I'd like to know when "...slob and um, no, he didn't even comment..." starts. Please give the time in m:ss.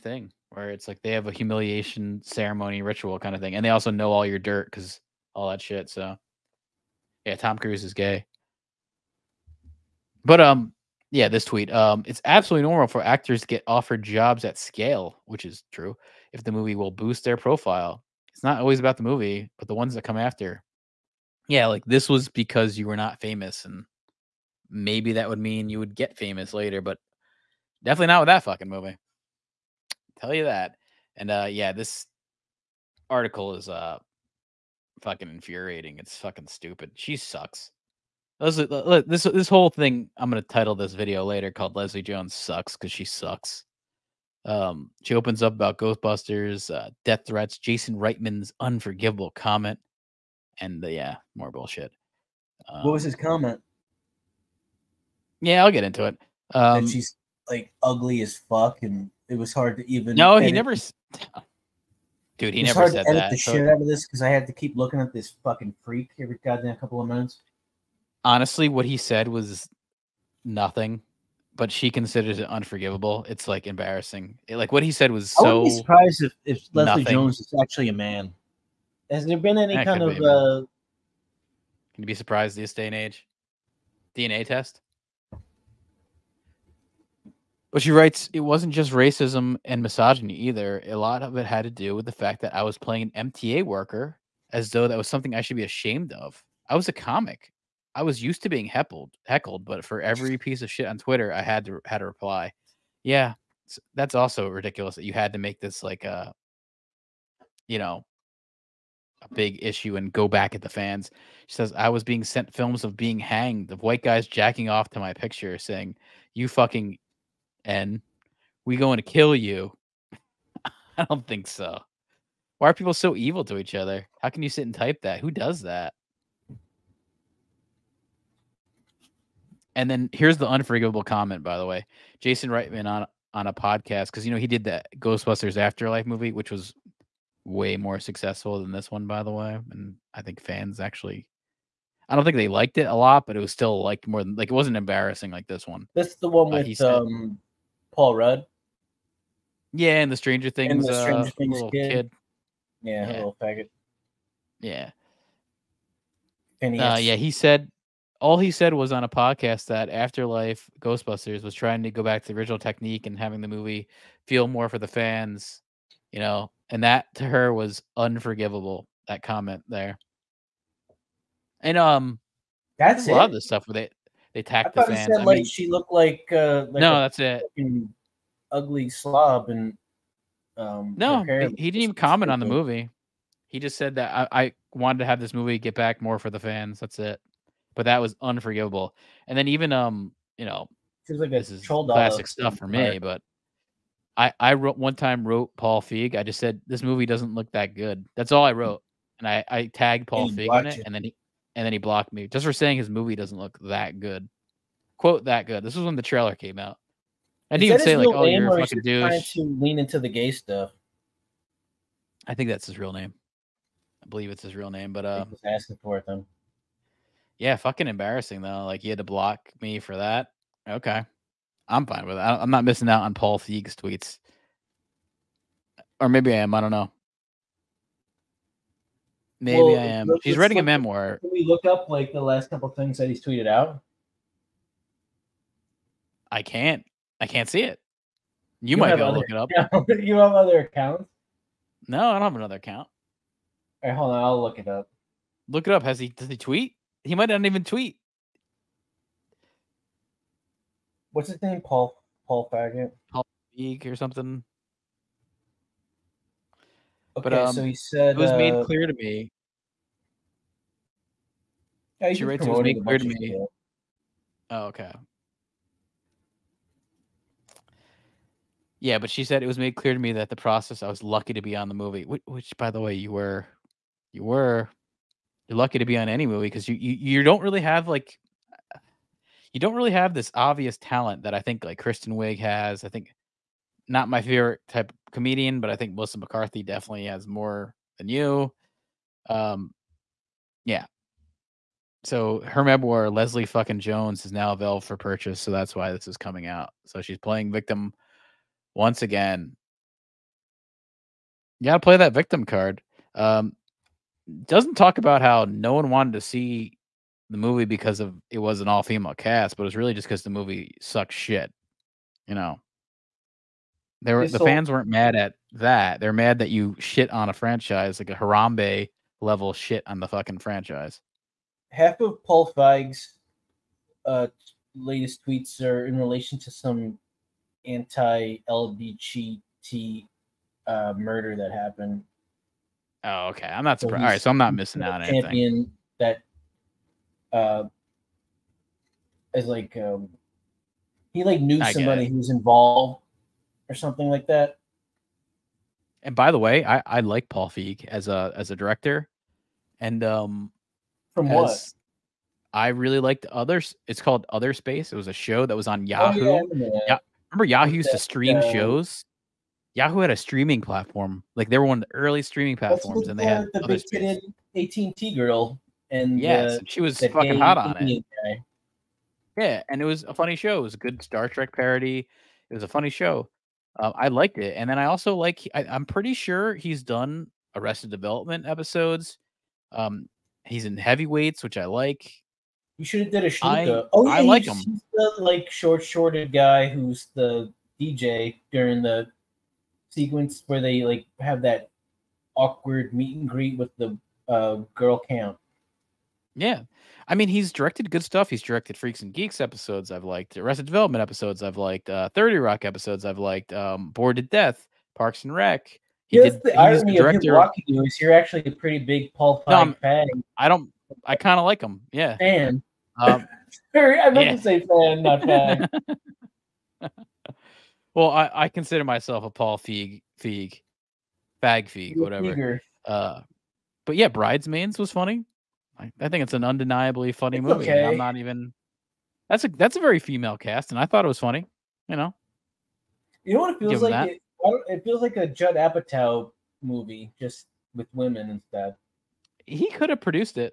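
2:58.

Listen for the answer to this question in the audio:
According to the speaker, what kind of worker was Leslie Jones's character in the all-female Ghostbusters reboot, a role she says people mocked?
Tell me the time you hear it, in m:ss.
1:33.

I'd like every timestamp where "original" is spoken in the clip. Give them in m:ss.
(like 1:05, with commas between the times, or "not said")
2:42.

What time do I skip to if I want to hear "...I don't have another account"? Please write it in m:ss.
4:02.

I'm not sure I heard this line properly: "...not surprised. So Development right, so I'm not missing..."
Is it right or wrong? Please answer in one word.
wrong.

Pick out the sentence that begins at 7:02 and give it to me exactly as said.
Uh, but yeah, Bridesmaids was funny.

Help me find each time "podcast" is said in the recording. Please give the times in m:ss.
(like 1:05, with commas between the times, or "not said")
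2:13, 2:39.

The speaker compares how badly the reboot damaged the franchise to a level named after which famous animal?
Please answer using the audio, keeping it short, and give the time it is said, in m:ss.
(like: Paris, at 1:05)
Harambe, at 5:18.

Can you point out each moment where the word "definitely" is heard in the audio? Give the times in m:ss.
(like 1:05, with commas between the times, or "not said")
0:27, 4:46.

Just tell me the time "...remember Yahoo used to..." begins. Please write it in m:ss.
5:57.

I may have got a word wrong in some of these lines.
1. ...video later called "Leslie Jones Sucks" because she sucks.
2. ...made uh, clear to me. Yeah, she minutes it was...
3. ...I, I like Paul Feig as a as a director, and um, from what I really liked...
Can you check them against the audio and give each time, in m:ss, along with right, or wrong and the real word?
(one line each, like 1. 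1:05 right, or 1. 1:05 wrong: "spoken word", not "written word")
1. 0:40 right
2. 4:18 wrong: "writes", not "minutes"
3. 5:46 right.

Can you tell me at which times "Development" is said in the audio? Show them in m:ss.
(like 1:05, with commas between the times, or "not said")
6:17, 6:40.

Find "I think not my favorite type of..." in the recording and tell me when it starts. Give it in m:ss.
4:42.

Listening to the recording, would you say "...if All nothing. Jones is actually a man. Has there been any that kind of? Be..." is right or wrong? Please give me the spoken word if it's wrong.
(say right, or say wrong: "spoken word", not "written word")
wrong: "Leslie", not "All".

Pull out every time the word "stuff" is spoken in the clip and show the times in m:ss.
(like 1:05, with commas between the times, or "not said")
2:53, 3:12, 3:30, 6:38.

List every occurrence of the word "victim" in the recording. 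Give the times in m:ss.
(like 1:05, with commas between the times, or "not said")
4:57, 5:02.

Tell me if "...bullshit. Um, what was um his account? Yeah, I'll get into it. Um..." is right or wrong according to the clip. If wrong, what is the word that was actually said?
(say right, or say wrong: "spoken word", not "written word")
wrong: "comment", not "account".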